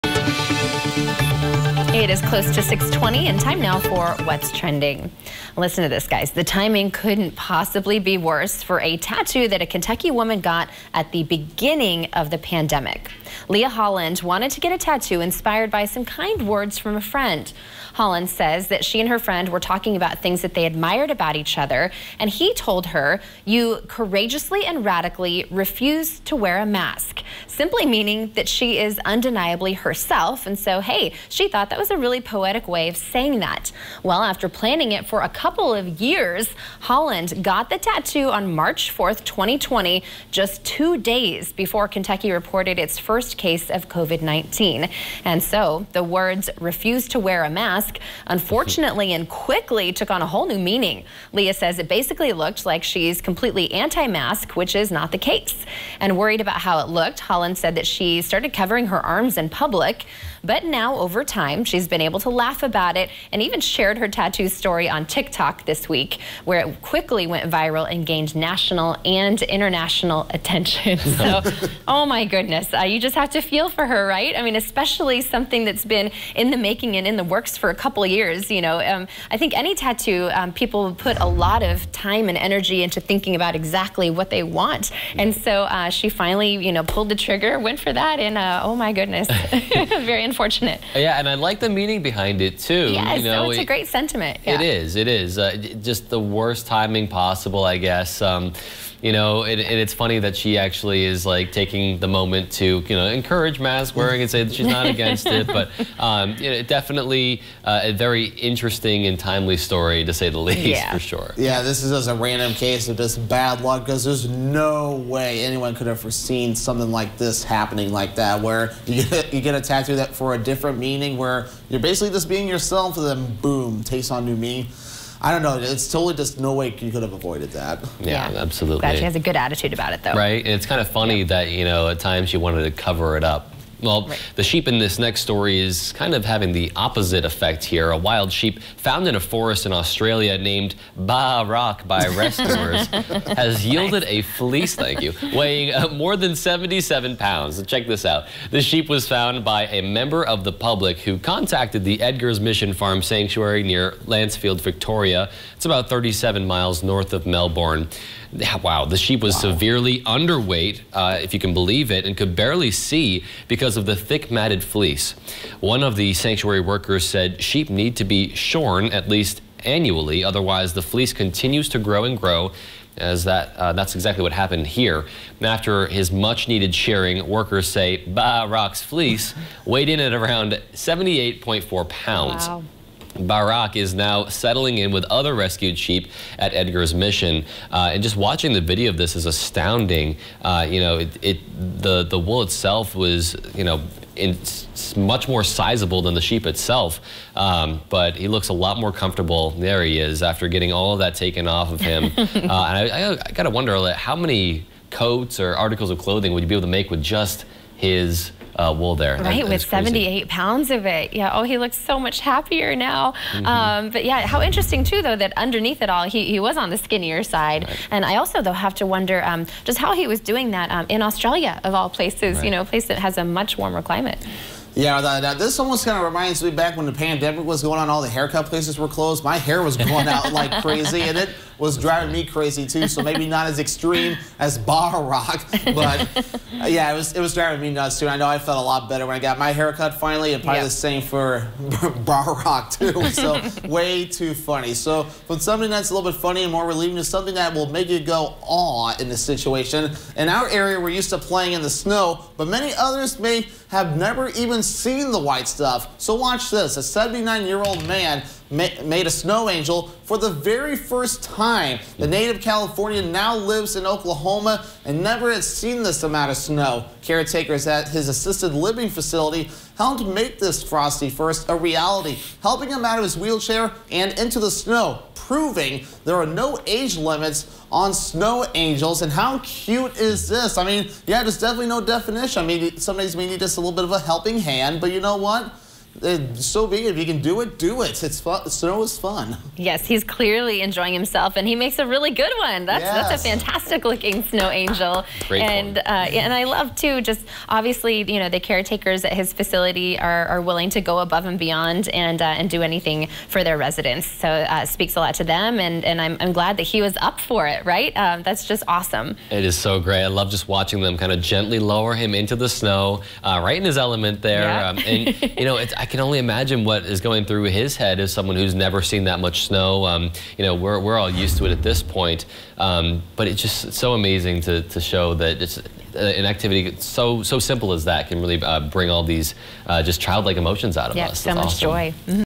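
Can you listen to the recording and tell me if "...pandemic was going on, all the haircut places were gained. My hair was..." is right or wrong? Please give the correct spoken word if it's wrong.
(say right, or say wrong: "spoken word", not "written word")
wrong: "closed", not "gained".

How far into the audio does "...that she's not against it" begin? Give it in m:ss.
1:44.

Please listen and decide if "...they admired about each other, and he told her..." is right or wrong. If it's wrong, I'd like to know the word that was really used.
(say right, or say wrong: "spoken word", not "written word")
right.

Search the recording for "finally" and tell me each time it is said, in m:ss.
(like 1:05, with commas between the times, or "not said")
1:26, 3:59.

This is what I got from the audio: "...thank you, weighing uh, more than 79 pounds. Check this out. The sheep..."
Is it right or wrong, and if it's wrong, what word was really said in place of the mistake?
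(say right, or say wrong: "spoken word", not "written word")
wrong: "77", not "79".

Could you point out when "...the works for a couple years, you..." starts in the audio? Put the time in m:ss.
1:17.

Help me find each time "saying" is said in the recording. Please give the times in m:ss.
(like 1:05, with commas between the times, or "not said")
0:32.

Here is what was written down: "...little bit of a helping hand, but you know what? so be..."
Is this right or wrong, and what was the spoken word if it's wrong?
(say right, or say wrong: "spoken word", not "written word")
right.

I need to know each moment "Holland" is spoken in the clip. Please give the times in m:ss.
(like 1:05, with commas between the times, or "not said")
0:13, 0:17, 0:36, 0:57.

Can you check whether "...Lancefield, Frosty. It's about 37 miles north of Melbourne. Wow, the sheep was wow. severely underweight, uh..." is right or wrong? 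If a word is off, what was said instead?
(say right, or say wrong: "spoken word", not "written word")
wrong: "Victoria", not "Frosty".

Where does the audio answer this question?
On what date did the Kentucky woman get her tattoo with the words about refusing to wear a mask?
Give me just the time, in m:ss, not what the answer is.
0:38.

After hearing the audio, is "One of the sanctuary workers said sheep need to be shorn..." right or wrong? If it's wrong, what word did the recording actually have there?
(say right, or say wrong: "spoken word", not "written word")
right.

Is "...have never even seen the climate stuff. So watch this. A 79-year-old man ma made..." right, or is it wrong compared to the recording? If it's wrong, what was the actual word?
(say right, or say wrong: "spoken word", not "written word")
wrong: "white", not "climate".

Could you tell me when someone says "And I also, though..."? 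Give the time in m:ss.
3:37.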